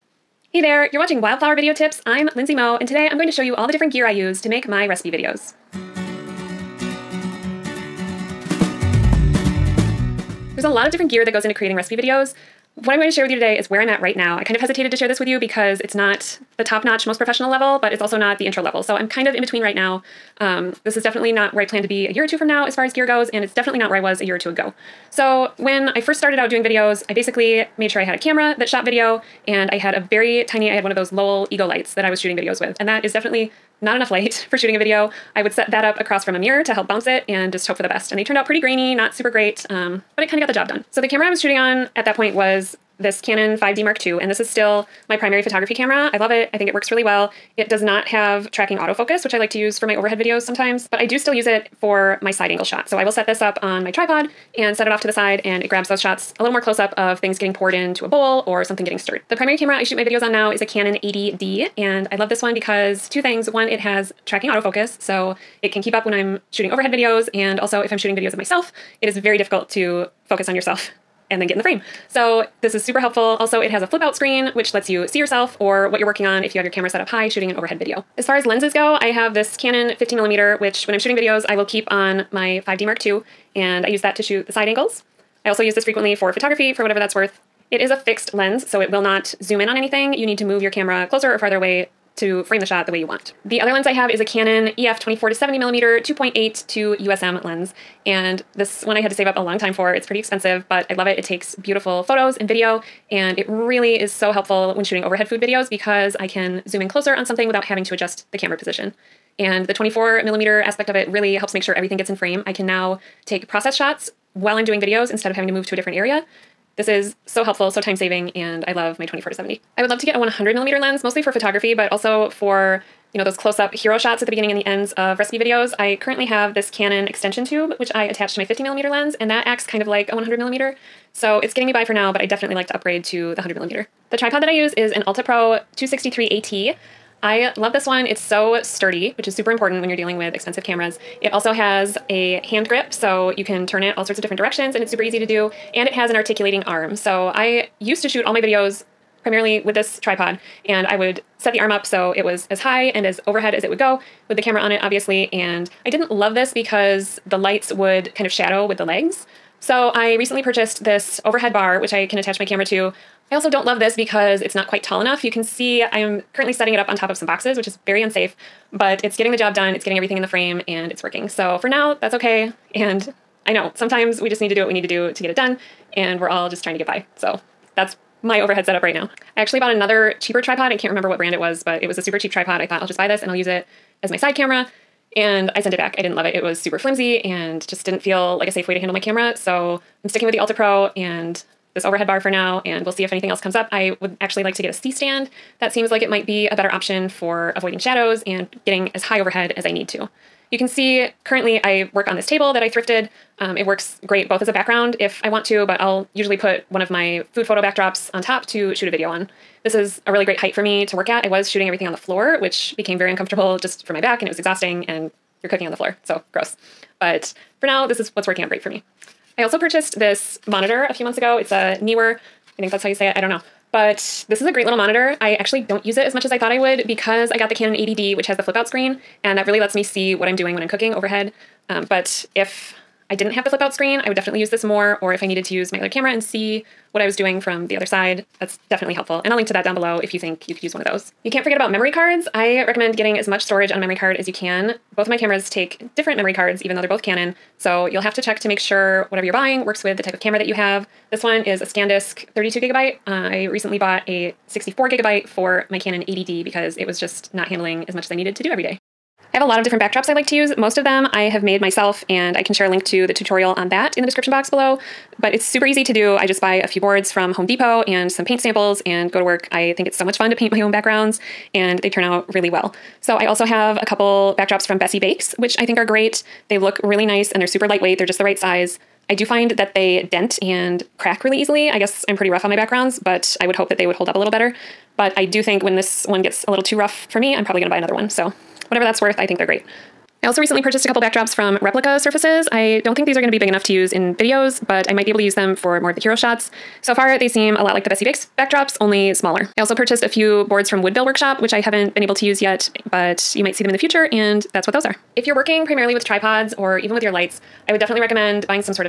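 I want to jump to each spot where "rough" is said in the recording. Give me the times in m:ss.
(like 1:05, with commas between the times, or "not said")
4:42, 4:46.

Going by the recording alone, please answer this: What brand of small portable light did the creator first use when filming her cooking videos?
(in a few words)
Lowell Ego.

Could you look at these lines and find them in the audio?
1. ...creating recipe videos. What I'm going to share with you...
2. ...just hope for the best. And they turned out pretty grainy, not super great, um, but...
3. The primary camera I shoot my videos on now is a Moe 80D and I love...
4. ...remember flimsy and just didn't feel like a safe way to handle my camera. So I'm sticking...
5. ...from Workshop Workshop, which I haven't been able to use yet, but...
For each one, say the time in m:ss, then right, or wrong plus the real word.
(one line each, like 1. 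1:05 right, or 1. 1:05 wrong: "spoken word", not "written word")
1. 0:11 right
2. 0:37 right
3. 0:59 wrong: "Canon", not "Moe"
4. 3:06 wrong: "super", not "remember"
5. 5:00 wrong: "Woodville", not "Workshop".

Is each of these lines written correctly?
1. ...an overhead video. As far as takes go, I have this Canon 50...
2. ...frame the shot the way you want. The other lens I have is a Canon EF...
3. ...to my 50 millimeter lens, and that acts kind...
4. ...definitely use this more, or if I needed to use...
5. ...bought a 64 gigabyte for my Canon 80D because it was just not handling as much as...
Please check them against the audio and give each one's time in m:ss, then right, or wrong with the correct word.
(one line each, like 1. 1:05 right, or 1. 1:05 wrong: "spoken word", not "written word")
1. 1:17 wrong: "lenses", not "takes"
2. 1:32 right
3. 2:08 right
4. 3:54 right
5. 4:13 right.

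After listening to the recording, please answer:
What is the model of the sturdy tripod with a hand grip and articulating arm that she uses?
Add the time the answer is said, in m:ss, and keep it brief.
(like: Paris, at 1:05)
Alta Pro 263 AT, at 2:15.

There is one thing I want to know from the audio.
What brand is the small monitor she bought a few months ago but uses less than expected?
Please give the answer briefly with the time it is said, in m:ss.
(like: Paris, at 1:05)
Neewer, at 3:41.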